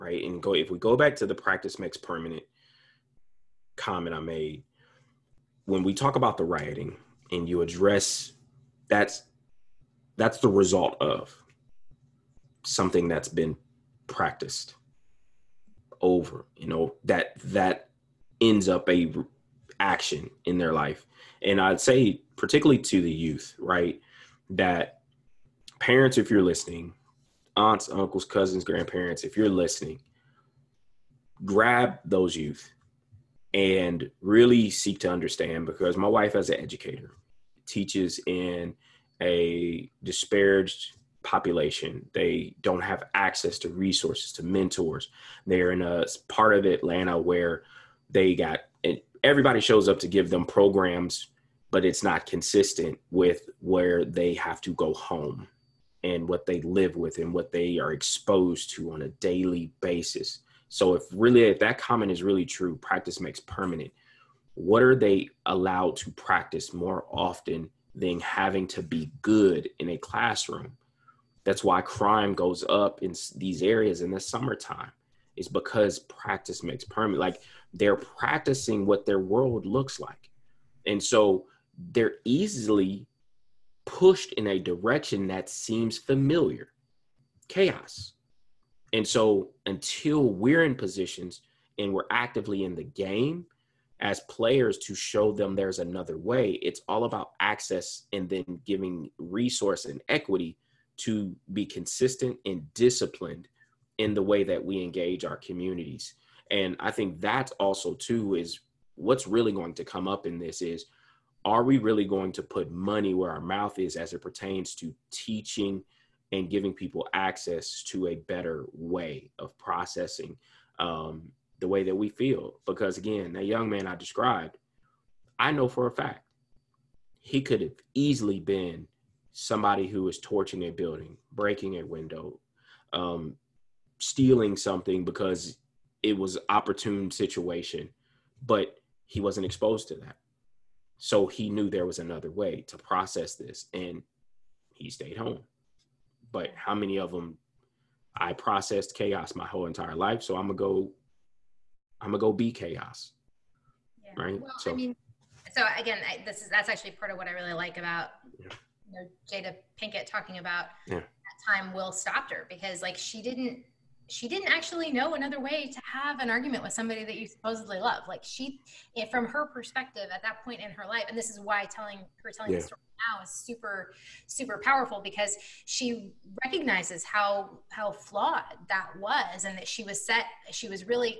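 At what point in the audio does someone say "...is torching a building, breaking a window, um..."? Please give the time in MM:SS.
02:10.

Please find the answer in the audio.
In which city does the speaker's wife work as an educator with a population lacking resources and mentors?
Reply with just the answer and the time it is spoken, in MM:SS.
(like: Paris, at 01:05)
Atlanta, at 00:46.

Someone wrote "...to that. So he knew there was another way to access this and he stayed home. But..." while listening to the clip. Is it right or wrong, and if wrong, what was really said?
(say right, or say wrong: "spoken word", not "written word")
wrong: "process", not "access".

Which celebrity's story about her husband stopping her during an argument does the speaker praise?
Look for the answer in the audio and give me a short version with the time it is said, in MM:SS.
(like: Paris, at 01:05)
Jada Pinkett, at 02:39.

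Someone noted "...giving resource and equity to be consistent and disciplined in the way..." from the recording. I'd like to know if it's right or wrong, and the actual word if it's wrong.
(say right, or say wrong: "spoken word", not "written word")
right.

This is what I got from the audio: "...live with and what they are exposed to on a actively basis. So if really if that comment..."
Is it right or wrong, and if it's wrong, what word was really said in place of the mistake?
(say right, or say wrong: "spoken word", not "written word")
wrong: "daily", not "actively".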